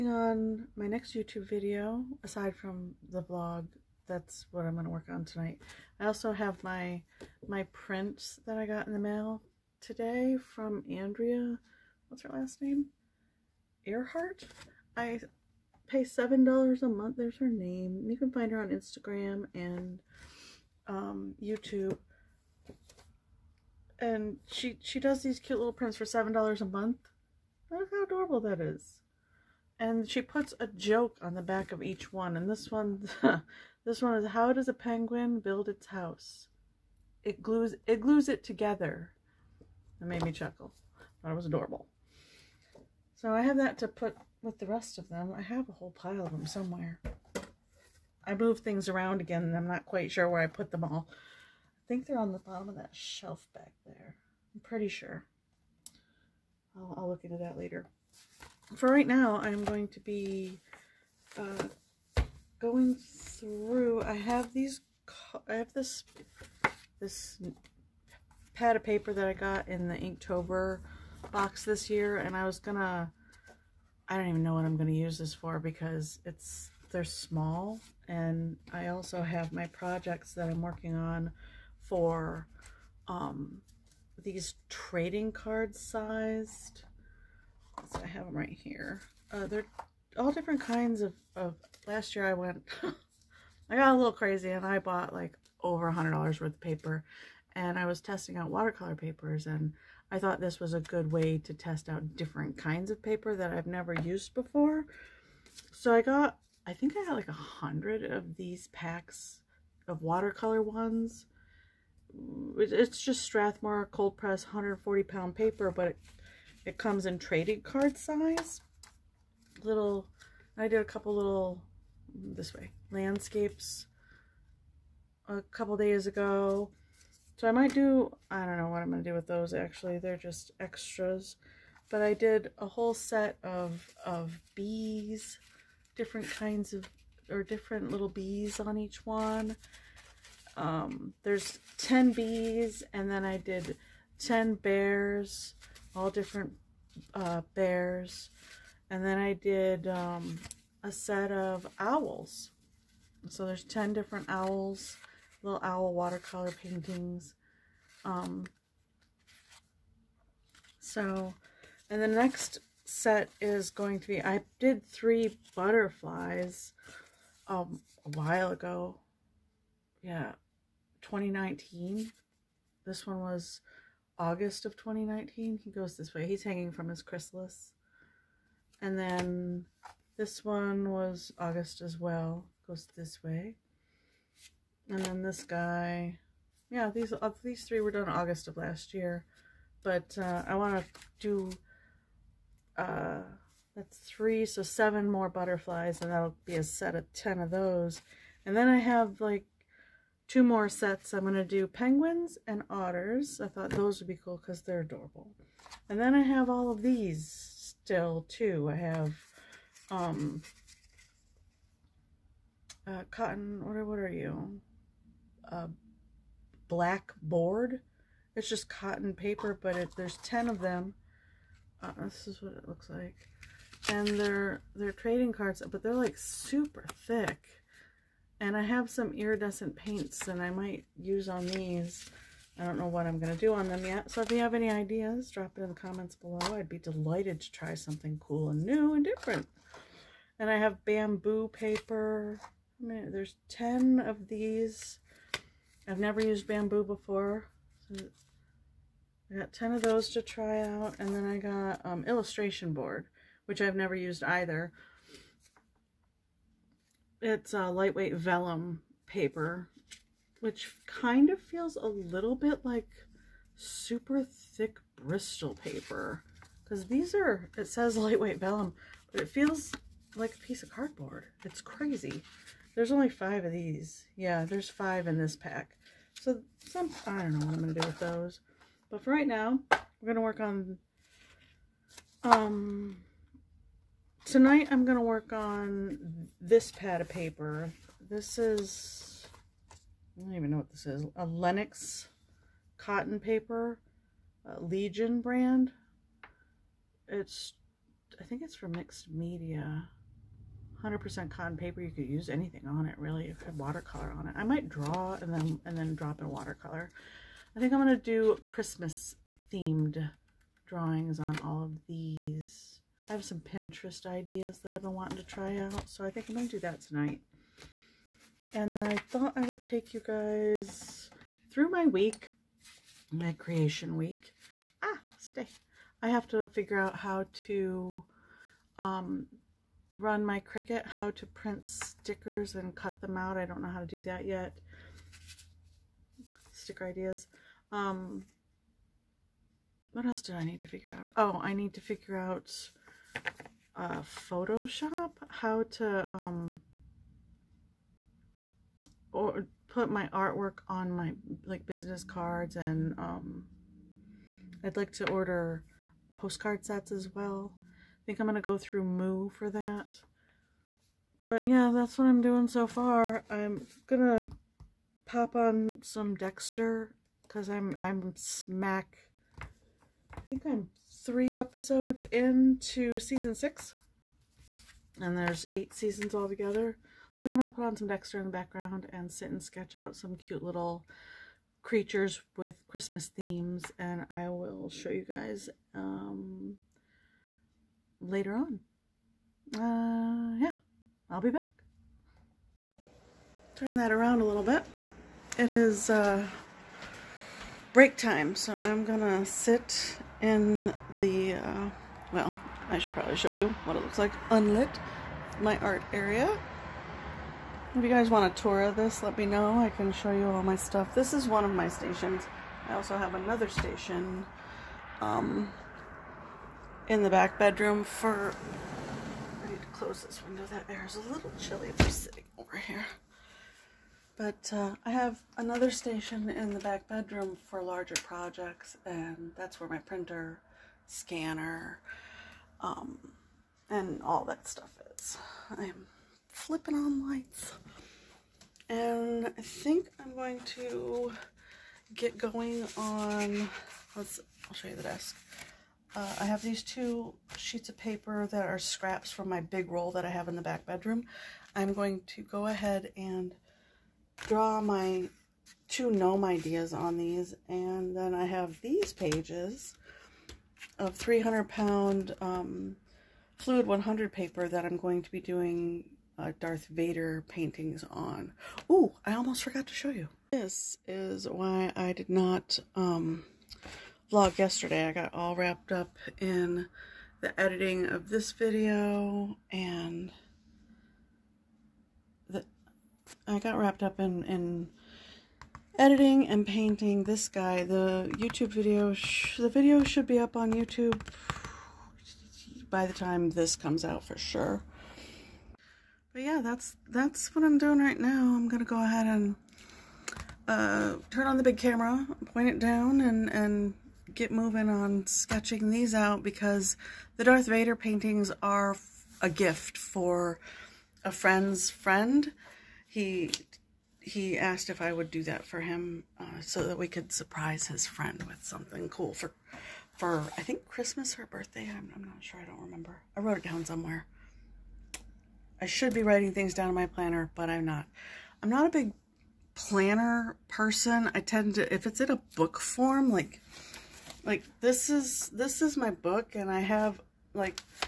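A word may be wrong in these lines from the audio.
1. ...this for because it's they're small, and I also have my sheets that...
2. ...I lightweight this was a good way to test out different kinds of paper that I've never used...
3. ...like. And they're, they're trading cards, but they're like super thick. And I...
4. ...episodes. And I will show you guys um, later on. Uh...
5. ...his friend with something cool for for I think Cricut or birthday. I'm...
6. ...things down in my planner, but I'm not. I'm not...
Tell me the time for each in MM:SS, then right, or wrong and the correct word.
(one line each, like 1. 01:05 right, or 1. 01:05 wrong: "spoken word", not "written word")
1. 01:15 wrong: "projects", not "sheets"
2. 01:40 wrong: "thought", not "lightweight"
3. 03:42 right
4. 06:23 wrong: "themes", not "episodes"
5. 08:37 wrong: "Christmas", not "Cricut"
6. 08:46 right.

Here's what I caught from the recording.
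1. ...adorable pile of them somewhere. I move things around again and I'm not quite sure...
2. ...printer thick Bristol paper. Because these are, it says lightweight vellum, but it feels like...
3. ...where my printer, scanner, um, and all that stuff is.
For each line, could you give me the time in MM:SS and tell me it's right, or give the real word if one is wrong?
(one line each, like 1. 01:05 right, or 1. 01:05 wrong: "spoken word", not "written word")
1. 00:45 wrong: "whole", not "adorable"
2. 04:23 wrong: "super", not "printer"
3. 07:09 right.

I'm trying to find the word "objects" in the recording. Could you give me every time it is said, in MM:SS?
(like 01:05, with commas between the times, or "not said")
not said.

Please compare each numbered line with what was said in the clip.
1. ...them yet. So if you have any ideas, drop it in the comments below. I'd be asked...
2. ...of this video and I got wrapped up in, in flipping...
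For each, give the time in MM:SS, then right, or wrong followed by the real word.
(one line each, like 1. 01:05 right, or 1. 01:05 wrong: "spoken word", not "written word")
1. 03:53 wrong: "delighted", not "asked"
2. 07:57 wrong: "editing", not "flipping".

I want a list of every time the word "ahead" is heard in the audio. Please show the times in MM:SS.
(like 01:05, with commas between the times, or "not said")
07:32, 08:18.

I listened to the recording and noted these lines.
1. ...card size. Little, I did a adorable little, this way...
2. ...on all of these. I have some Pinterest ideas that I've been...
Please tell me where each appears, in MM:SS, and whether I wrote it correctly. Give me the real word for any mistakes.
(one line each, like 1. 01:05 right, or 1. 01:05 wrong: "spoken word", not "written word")
1. 01:57 wrong: "couple", not "adorable"
2. 05:11 right.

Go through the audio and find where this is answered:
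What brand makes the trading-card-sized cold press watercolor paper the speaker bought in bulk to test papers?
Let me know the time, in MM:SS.
01:53.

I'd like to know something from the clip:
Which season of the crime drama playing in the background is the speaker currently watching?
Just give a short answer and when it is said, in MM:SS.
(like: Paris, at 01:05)
season six, at 06:12.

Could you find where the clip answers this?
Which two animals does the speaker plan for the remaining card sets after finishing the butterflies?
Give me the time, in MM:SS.
03:21.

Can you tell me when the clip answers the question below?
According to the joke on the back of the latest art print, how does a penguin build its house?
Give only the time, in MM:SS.
00:37.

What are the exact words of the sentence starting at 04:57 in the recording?
It's, I think it's for mixed media.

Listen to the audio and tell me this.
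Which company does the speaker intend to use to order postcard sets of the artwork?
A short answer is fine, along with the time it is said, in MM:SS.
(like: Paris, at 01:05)
Moo, at 05:58.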